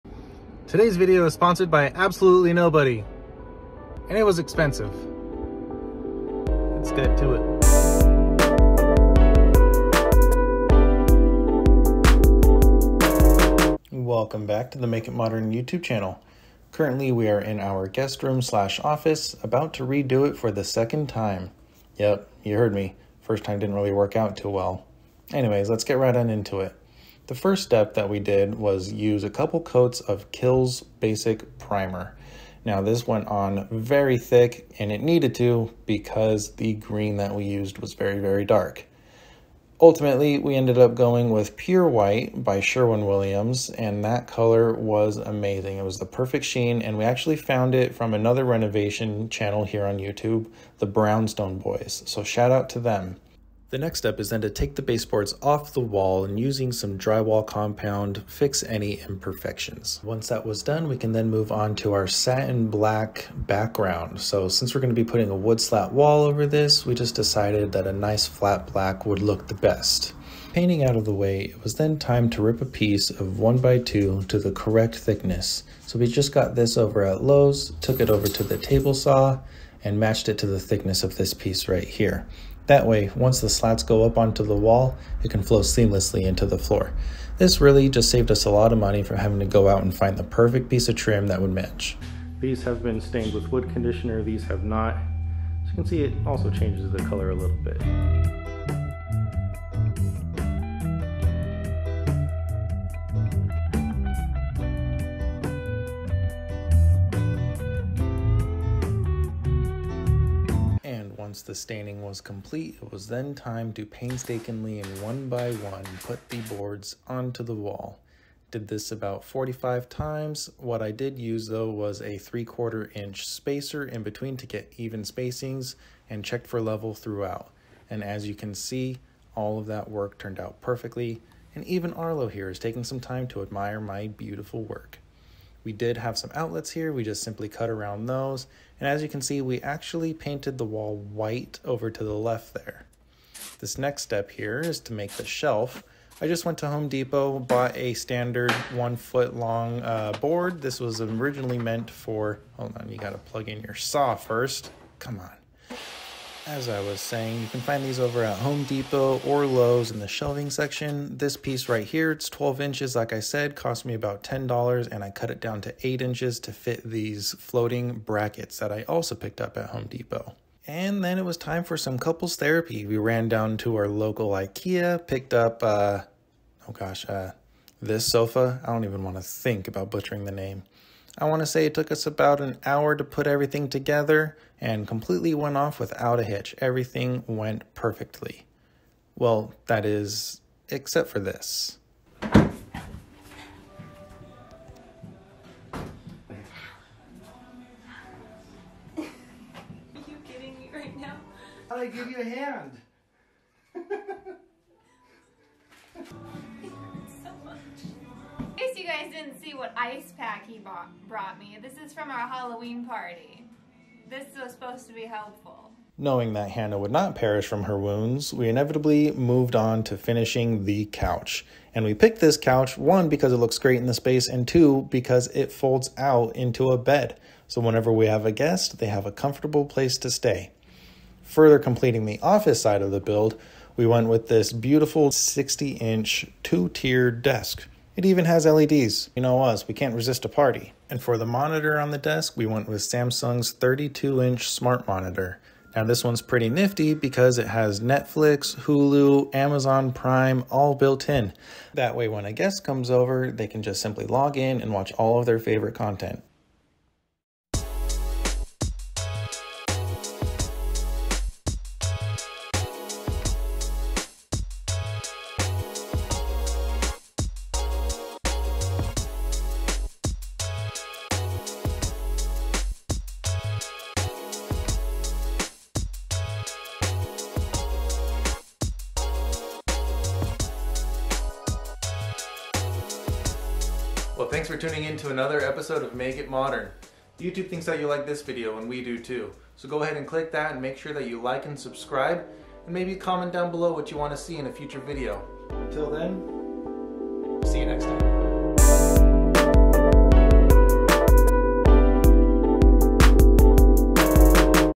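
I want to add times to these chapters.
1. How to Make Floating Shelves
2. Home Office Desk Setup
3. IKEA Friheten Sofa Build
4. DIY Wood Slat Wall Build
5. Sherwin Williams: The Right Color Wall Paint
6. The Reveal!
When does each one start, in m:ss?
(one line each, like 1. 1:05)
1. 2:20
2. 3:50
3. 2:50
4. 1:10
5. 0:30
6. 4:15.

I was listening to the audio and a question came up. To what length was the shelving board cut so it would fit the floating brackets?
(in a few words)
8 inches.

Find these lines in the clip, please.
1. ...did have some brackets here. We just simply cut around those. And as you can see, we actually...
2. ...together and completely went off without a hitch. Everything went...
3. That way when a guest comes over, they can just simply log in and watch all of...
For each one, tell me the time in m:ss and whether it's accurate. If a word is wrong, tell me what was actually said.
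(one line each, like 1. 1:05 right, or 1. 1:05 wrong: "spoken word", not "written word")
1. 2:15 wrong: "outlets", not "brackets"
2. 3:03 right
3. 4:11 right.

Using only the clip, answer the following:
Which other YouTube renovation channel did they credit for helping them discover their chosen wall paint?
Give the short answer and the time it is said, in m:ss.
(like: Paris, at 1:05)
Brownstone Boys, at 0:50.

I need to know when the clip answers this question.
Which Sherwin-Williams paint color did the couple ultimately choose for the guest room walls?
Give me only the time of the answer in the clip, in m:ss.
0:41.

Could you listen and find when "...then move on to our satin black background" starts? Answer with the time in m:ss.
1:01.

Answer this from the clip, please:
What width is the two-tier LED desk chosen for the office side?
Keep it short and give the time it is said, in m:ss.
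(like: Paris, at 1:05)
60 inch, at 3:55.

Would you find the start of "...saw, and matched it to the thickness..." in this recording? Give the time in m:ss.
1:18.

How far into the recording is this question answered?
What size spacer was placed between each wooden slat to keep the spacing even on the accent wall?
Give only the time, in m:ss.
2:02.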